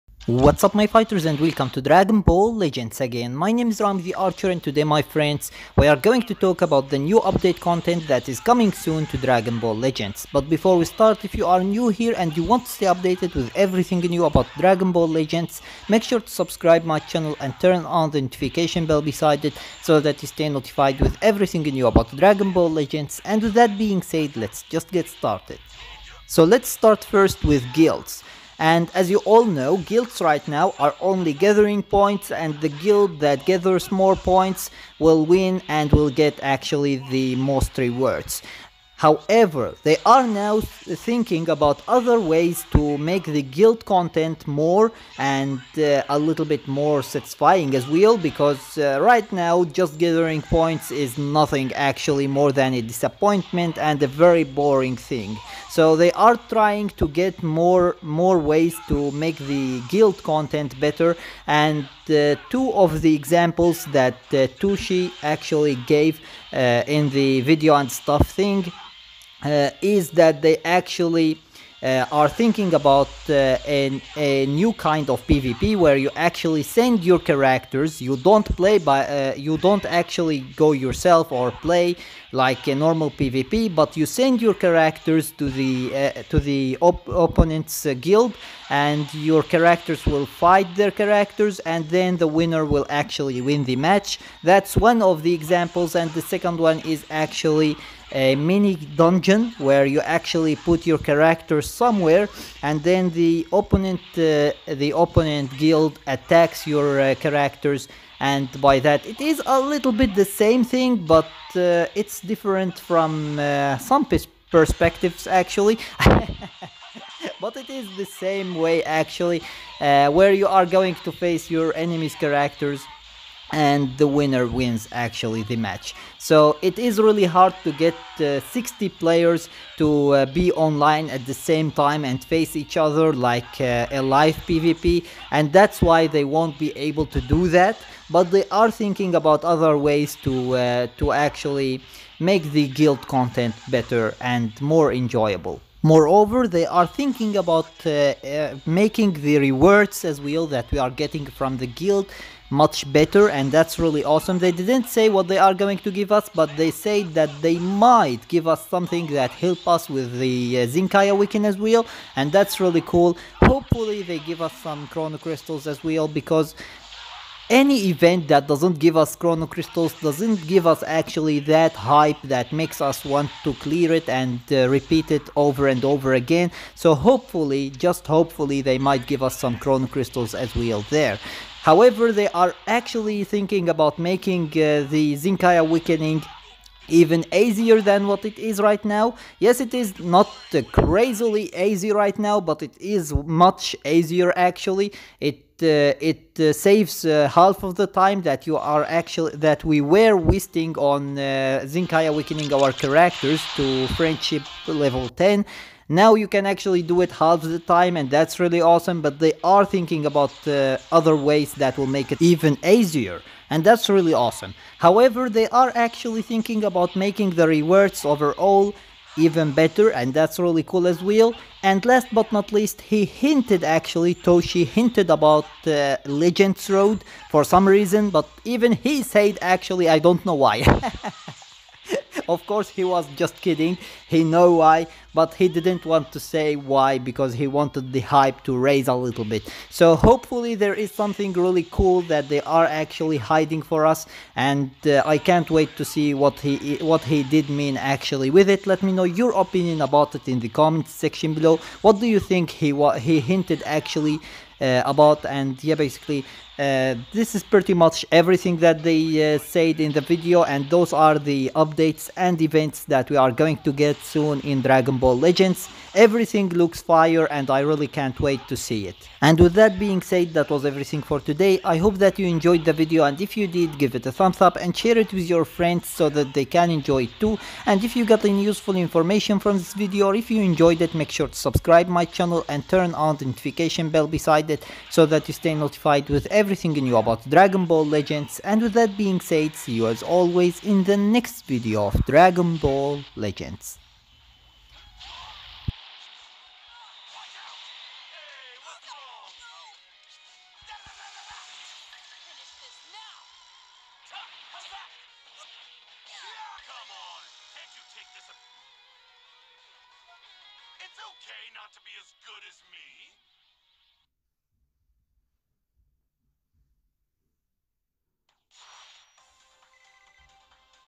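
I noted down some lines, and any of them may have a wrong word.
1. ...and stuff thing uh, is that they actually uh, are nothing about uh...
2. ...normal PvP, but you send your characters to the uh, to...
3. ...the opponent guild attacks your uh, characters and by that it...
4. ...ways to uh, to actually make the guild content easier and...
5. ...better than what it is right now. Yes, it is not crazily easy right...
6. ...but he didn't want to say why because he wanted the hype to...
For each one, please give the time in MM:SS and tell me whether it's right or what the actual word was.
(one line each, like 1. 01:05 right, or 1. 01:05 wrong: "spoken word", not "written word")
1. 01:07 wrong: "thinking", not "nothing"
2. 01:22 right
3. 01:44 right
4. 02:19 wrong: "better", not "easier"
5. 03:07 wrong: "easier", not "better"
6. 03:55 right.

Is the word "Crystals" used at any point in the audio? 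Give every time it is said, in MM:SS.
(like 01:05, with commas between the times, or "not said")
02:45, 02:49, 02:59.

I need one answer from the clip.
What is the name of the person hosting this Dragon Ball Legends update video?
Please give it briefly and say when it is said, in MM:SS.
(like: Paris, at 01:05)
Ramzi Archer, at 00:03.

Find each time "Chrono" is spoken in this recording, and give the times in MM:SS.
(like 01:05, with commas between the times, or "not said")
02:44, 02:49, 02:59.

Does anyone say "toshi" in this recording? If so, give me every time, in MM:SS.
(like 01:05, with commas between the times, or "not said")
01:04, 03:44.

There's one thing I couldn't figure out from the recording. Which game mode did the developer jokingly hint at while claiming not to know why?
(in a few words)
Legends Road.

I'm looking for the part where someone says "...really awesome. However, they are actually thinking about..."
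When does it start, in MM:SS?
03:33.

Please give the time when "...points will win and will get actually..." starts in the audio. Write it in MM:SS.
00:34.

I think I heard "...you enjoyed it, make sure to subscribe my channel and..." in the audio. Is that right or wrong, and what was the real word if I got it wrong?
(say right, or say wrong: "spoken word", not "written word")
right.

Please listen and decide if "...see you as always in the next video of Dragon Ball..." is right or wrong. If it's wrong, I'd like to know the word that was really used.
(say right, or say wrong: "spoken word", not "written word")
right.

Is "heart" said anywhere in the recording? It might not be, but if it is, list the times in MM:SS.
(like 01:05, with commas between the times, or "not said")
not said.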